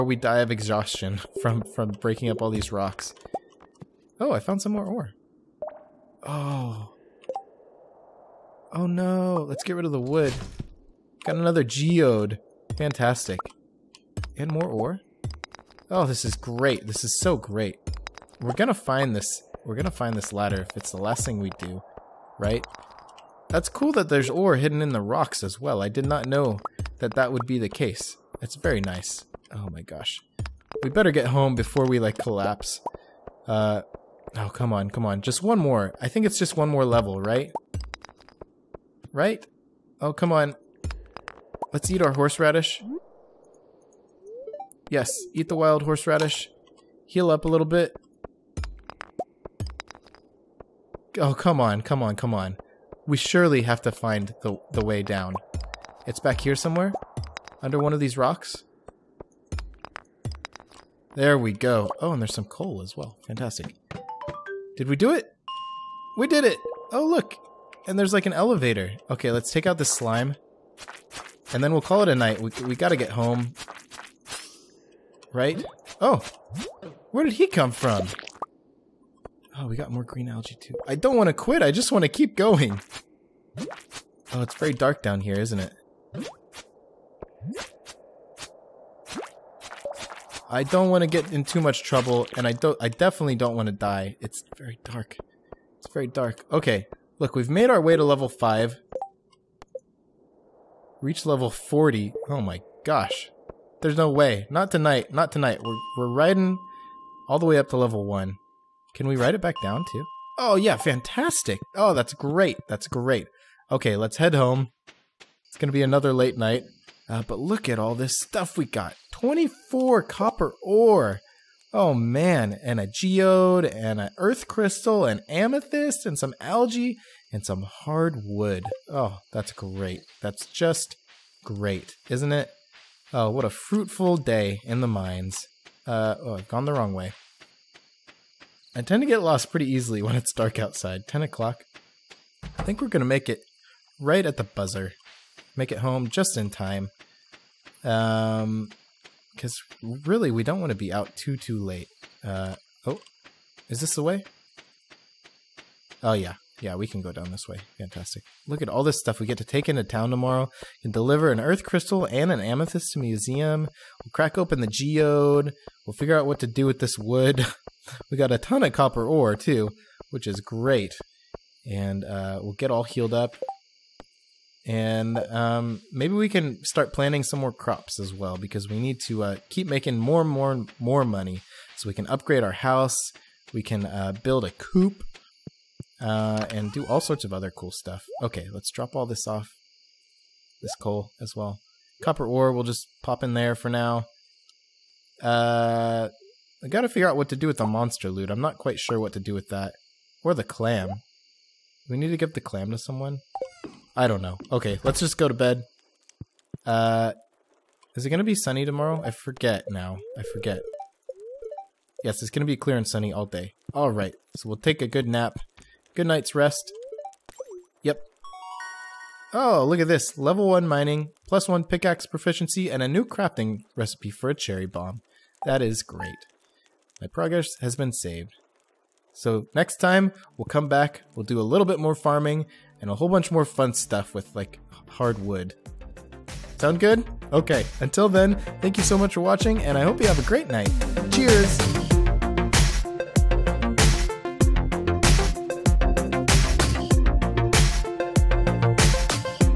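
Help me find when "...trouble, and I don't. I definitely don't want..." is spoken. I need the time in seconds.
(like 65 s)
91 s.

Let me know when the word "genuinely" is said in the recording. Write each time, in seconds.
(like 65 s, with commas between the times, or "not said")
not said.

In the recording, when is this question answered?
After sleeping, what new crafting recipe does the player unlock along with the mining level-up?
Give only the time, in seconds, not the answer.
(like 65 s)
224 s.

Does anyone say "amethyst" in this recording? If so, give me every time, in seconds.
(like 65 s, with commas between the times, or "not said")
125 s, 162 s.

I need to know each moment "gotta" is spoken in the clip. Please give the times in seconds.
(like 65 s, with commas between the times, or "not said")
72 s, 196 s.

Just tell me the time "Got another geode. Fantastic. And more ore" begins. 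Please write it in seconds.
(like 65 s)
11 s.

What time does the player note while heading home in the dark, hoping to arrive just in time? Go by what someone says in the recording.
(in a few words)
10 o'clock.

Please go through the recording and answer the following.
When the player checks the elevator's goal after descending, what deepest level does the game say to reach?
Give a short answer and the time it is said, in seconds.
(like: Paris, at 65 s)
Level 40, at 101 s.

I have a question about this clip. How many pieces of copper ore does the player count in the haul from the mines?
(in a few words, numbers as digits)
24.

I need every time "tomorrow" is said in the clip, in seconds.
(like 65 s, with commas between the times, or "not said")
160 s, 208 s.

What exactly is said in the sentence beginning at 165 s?
We'll figure out what to do with this wood.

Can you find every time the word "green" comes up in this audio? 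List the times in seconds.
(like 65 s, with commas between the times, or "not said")
80 s.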